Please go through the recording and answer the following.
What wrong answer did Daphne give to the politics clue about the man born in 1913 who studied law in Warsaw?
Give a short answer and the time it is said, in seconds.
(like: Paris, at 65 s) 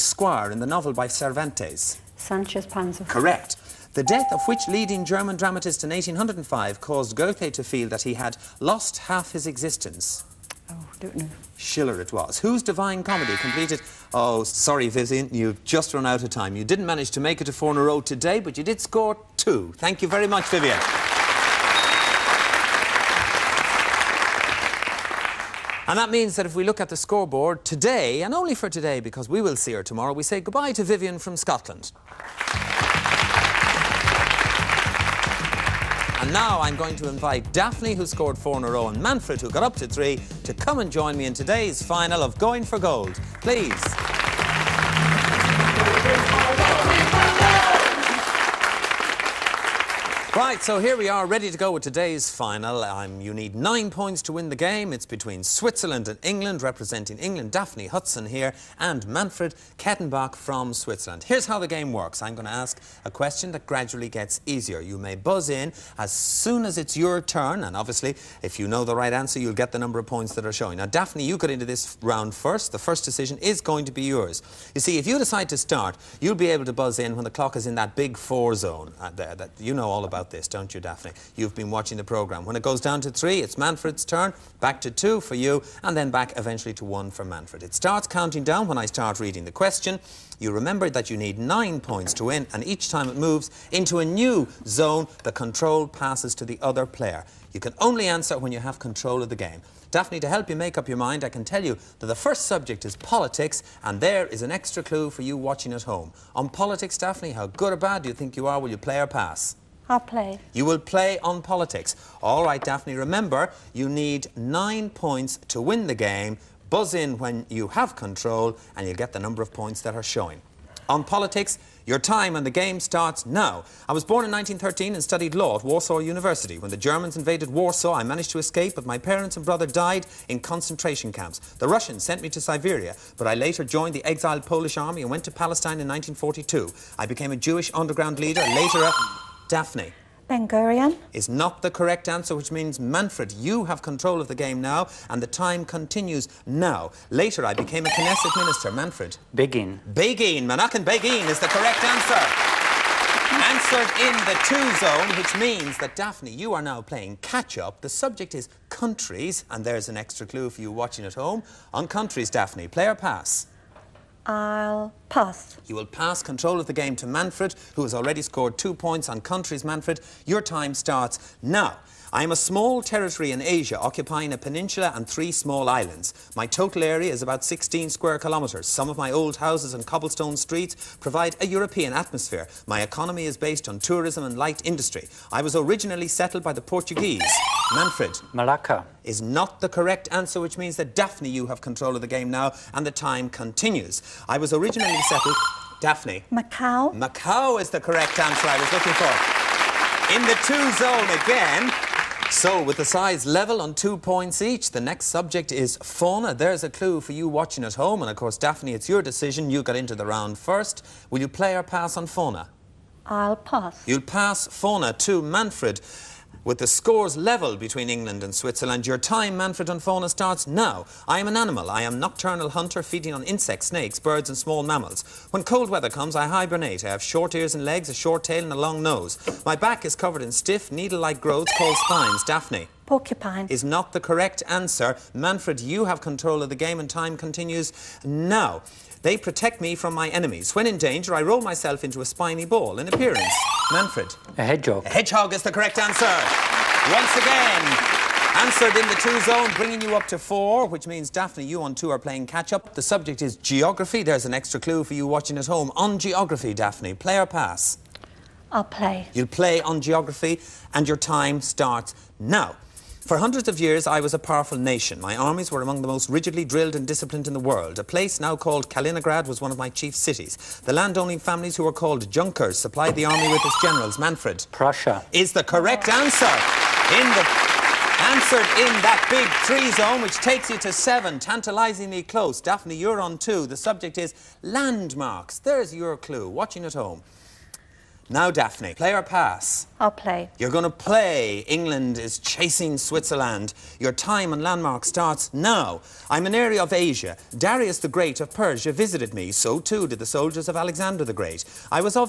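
Ben Gurion, at 140 s.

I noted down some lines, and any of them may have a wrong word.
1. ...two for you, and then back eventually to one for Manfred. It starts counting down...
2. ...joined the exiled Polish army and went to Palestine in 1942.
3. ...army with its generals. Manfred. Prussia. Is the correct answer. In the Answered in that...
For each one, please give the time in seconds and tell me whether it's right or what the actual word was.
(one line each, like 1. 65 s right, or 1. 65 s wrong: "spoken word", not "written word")
1. 84 s right
2. 133 s right
3. 273 s right.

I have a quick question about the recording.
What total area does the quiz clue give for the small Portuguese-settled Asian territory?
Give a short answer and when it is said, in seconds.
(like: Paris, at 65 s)
About 16 square kilometres, at 177 s.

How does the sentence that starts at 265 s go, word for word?
My armies were among the most rigidly drilled and disciplined in the world.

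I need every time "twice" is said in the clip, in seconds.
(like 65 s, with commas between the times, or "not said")
not said.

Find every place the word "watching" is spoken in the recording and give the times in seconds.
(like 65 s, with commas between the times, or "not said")
81 s, 105 s, 160 s, 207 s, 255 s, 286 s.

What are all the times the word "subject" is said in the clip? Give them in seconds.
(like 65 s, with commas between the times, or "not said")
102 s, 157 s, 205 s, 252 s, 283 s.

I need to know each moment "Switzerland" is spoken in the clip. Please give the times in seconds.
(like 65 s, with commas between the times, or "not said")
55 s, 60 s, 218 s, 292 s.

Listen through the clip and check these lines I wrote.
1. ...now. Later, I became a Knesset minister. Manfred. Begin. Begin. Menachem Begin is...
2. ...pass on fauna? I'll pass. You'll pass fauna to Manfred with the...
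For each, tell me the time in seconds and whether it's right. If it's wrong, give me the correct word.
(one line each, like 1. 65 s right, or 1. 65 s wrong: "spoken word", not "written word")
1. 146 s right
2. 211 s right.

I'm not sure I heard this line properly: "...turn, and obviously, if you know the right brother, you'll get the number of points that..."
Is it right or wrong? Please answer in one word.
wrong.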